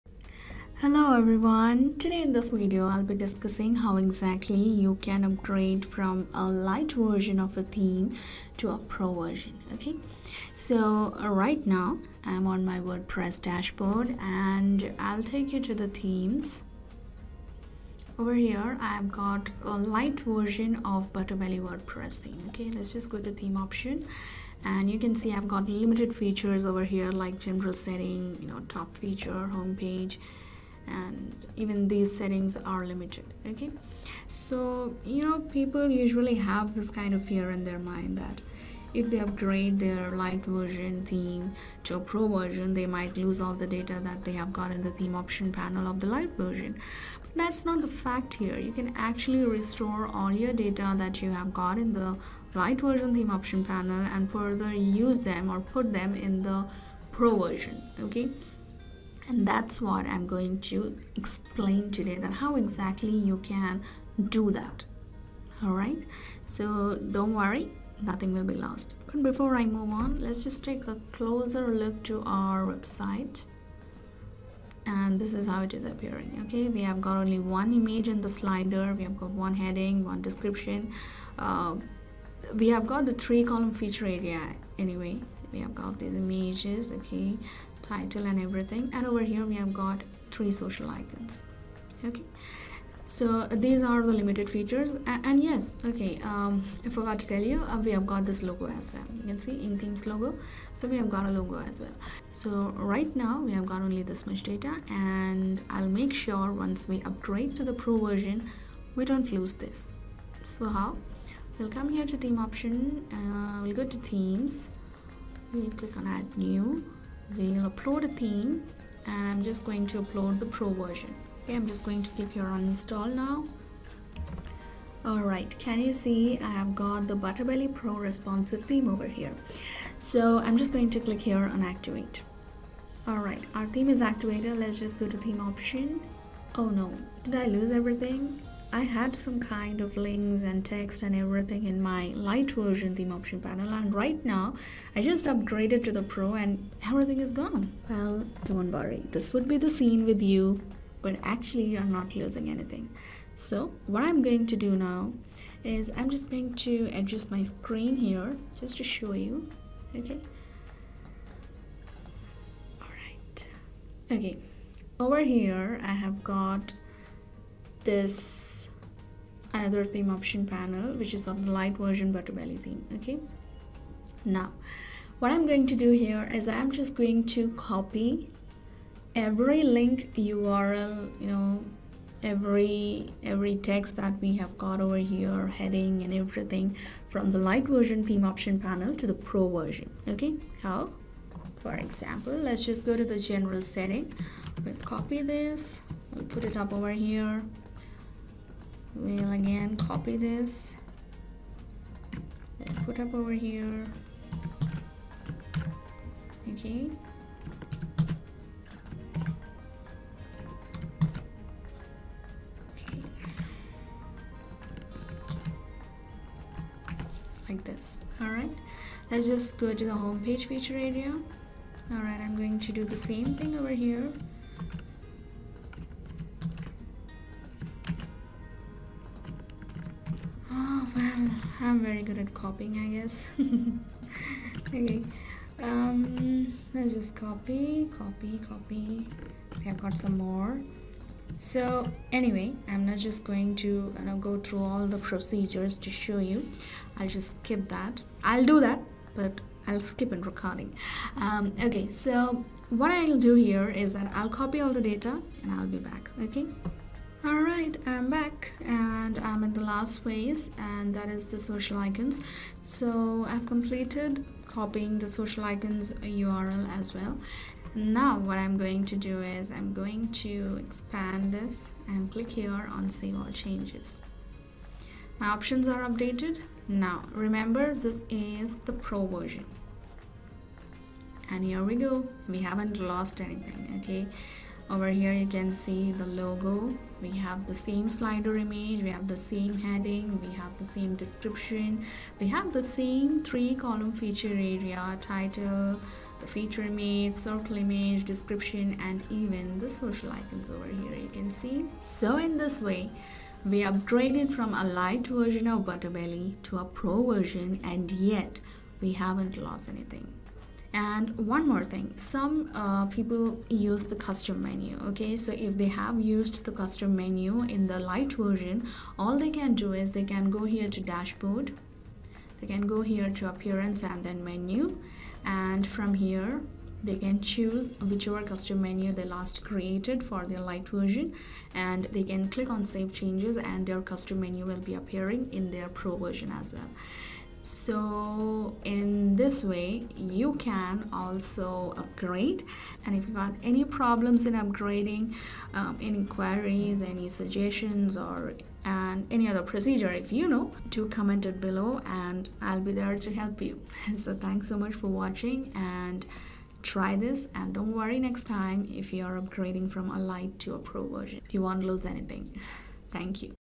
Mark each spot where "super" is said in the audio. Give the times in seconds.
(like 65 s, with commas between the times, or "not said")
not said.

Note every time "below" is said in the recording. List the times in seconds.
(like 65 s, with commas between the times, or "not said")
351 s.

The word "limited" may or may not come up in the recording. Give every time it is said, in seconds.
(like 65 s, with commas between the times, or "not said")
25 s, 32 s, 94 s.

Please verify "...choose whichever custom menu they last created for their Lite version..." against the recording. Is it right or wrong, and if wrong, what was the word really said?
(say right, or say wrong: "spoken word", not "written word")
right.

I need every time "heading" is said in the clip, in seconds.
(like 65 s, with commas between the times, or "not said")
79 s, 185 s, 289 s.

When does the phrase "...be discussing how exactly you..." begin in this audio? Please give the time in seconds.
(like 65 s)
3 s.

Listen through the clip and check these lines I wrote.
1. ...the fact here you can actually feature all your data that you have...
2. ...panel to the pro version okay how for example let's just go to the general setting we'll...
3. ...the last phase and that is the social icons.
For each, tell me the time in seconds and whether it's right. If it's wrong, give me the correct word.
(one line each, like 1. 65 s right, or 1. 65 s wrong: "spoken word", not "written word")
1. 47 s wrong: "restore", not "feature"
2. 188 s right
3. 259 s right.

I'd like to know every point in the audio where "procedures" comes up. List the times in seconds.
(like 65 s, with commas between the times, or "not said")
244 s, 349 s.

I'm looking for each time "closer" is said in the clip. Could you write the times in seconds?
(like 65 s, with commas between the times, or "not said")
71 s.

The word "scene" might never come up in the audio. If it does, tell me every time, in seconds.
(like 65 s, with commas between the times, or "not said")
149 s.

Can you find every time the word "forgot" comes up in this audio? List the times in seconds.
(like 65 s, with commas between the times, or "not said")
96 s.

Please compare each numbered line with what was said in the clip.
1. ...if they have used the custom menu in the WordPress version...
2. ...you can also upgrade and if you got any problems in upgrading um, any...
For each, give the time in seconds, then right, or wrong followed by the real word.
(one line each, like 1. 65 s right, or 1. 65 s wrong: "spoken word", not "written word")
1. 315 s wrong: "Lite", not "WordPress"
2. 339 s right.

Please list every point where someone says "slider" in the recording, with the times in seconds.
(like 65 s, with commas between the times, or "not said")
78 s, 287 s.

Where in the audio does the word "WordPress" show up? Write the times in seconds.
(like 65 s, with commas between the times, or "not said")
12 s, 21 s.